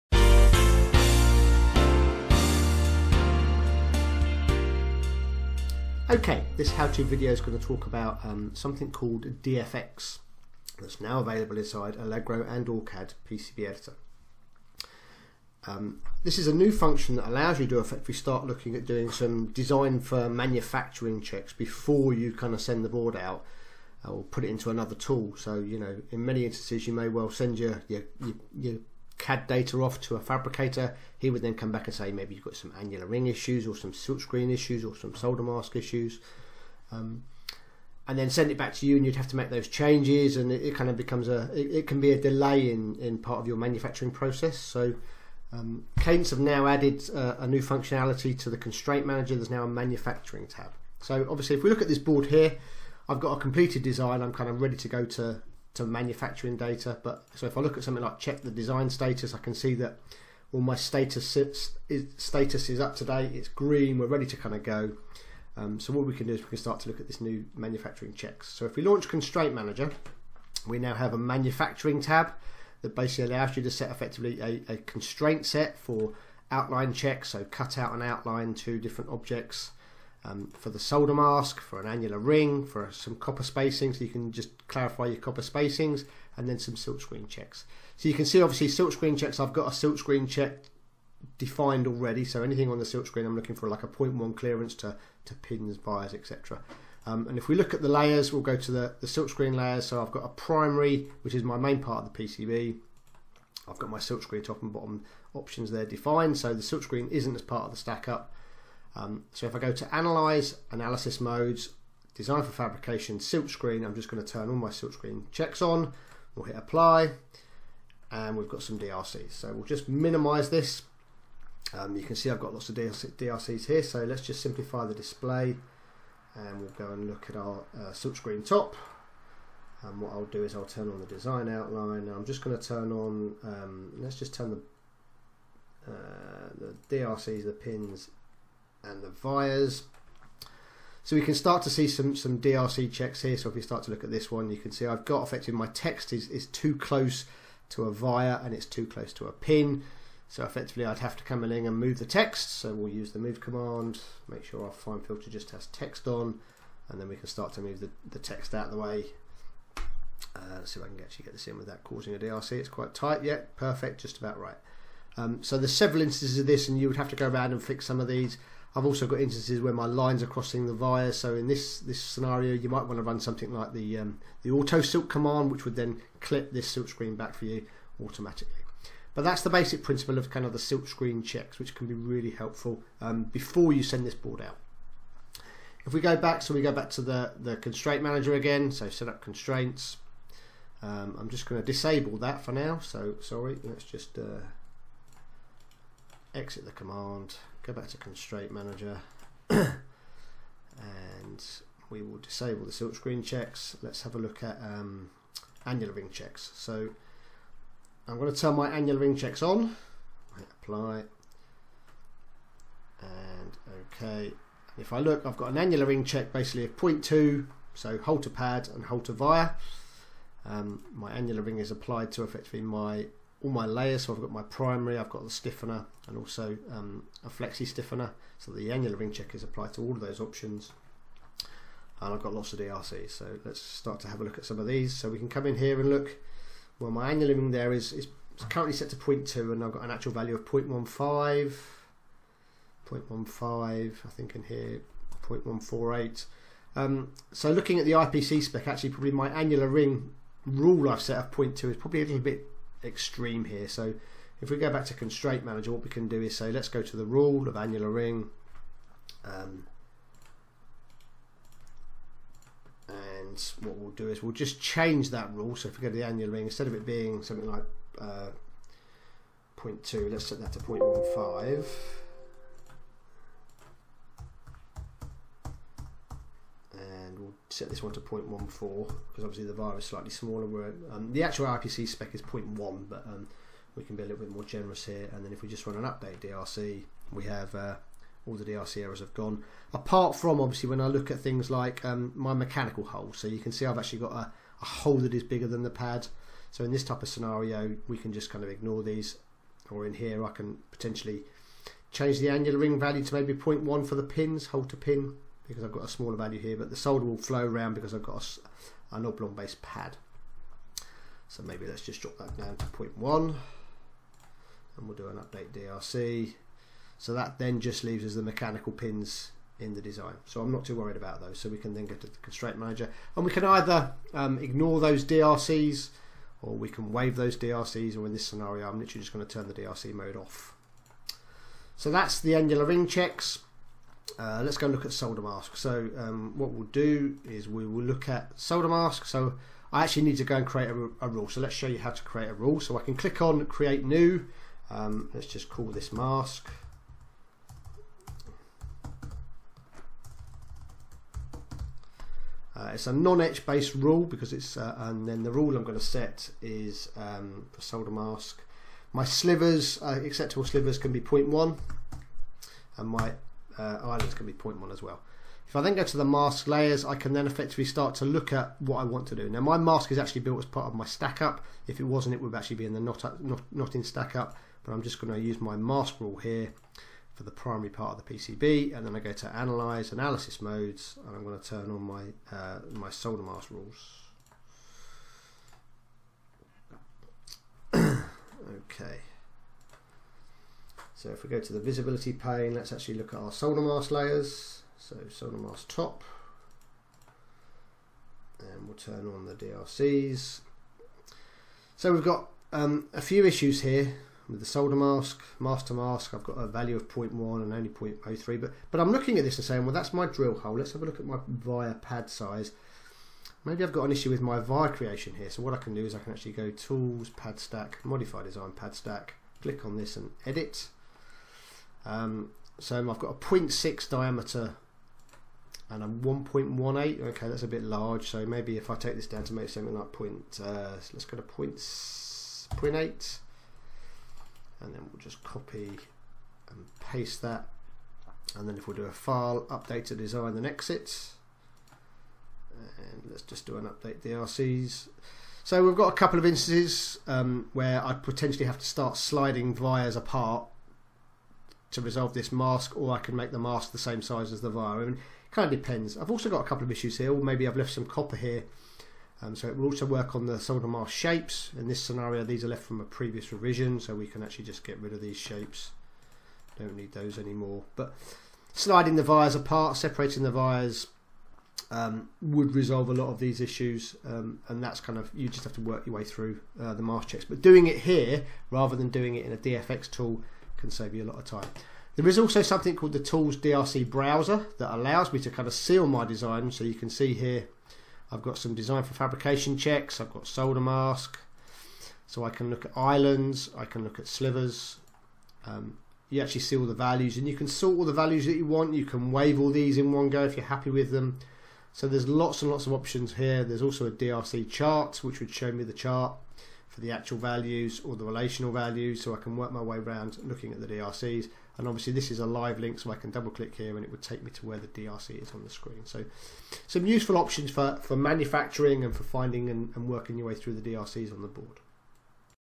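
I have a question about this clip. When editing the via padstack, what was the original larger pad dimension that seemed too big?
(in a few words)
1.18.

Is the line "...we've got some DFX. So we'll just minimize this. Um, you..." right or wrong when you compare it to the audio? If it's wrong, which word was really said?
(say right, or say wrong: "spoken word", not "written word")
wrong: "DRCs", not "DFX".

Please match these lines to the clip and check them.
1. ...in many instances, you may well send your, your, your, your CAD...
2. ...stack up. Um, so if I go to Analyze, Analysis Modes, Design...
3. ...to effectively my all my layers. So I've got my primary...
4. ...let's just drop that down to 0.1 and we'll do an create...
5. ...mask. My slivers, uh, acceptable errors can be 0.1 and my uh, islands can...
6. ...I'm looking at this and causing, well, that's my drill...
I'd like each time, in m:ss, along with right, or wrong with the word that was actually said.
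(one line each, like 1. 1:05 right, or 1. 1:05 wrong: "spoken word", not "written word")
1. 0:26 right
2. 1:47 right
3. 3:42 right
4. 5:11 wrong: "update", not "create"
5. 5:57 wrong: "slivers", not "errors"
6. 6:48 wrong: "saying", not "causing".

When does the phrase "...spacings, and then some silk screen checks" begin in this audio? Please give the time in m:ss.
1:25.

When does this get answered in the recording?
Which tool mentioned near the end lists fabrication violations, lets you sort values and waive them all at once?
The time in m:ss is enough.
8:02.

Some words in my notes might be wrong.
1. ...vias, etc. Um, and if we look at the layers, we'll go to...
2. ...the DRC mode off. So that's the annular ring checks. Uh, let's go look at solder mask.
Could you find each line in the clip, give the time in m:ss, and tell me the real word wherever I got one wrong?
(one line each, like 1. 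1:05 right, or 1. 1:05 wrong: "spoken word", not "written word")
1. 1:35 right
2. 5:29 right.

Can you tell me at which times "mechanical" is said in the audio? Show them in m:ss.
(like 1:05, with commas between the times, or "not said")
4:52, 5:18.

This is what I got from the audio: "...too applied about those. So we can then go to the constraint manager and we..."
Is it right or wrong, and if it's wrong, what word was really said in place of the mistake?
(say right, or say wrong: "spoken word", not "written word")
wrong: "worried", not "applied".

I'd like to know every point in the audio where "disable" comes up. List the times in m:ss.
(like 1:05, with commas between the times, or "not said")
3:11, 3:22.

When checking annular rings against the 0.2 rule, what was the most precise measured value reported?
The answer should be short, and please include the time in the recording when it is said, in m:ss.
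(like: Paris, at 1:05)
0.148, at 4:05.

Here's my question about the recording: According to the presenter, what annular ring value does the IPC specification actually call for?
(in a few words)
0.1.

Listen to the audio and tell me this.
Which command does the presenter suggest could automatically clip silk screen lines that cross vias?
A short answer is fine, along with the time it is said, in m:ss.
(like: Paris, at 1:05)
auto silk, at 2:54.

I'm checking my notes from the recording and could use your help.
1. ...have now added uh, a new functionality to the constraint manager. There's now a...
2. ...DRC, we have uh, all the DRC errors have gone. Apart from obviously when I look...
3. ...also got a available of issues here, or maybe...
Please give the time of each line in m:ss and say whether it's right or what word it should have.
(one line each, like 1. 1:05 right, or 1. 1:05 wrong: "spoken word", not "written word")
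1. 0:46 right
2. 4:46 right
3. 7:36 wrong: "couple", not "available".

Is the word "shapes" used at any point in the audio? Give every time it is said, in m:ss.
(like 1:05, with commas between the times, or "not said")
7:40, 7:45.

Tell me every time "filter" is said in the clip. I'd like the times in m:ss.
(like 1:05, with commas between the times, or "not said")
2:35.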